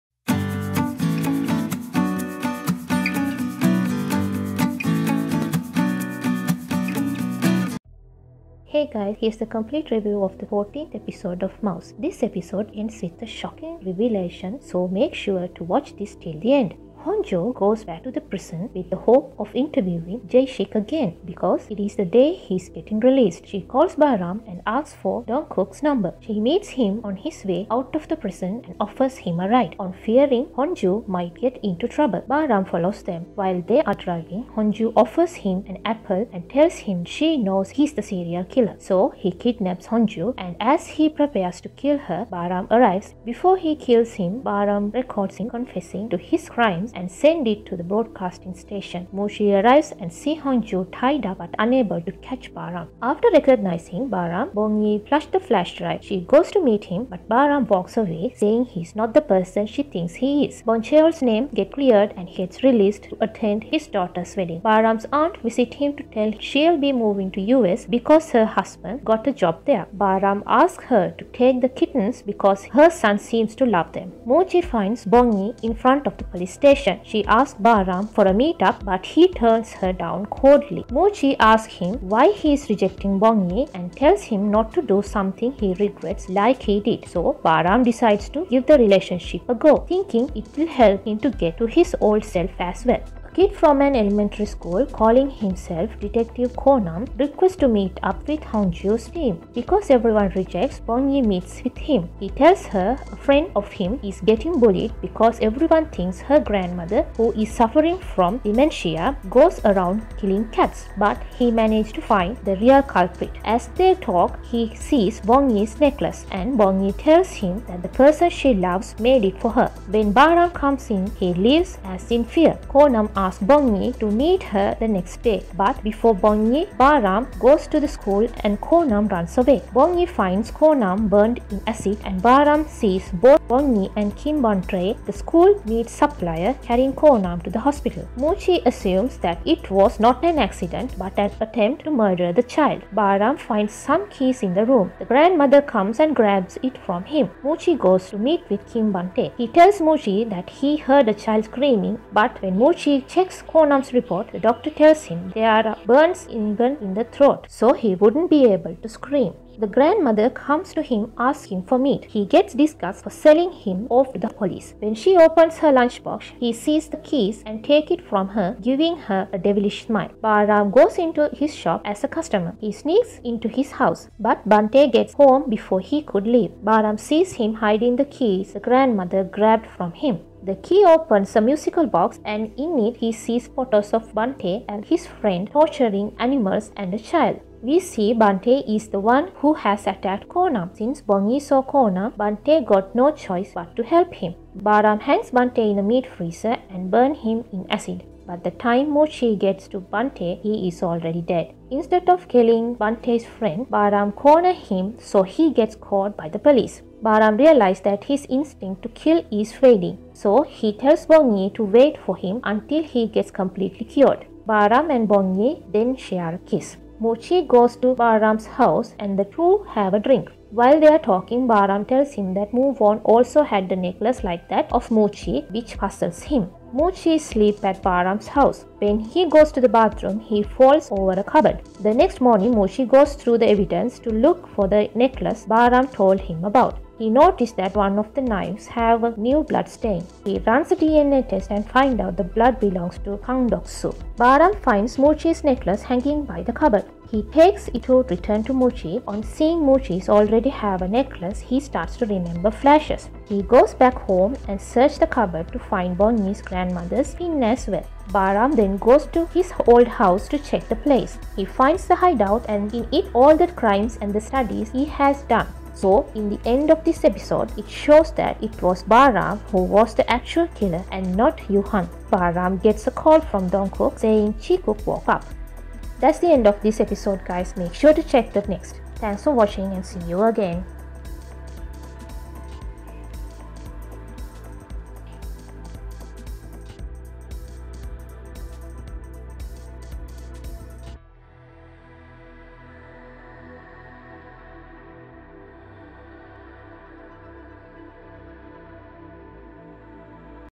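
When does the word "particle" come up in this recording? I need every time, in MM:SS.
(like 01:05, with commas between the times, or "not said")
not said.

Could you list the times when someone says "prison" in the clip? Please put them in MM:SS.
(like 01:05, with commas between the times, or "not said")
00:18, 00:28.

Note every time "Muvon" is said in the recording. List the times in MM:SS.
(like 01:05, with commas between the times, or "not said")
03:42.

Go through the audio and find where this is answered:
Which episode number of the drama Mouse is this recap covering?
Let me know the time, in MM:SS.
00:10.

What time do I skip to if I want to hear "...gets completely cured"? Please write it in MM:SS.
03:33.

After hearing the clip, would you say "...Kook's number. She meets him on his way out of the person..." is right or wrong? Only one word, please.
wrong.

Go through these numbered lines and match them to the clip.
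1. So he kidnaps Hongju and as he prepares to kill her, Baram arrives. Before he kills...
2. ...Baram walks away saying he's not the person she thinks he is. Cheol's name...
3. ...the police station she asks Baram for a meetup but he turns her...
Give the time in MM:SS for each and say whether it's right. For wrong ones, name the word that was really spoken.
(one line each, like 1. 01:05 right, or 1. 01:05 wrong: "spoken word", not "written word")
1. 00:38 right
2. 00:57 right
3. 01:16 right.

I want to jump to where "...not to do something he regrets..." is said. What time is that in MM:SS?
01:24.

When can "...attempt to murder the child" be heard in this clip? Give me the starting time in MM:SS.
02:21.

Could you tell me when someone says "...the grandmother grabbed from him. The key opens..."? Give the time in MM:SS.
02:58.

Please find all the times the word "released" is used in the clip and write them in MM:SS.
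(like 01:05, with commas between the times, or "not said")
00:22, 01:02.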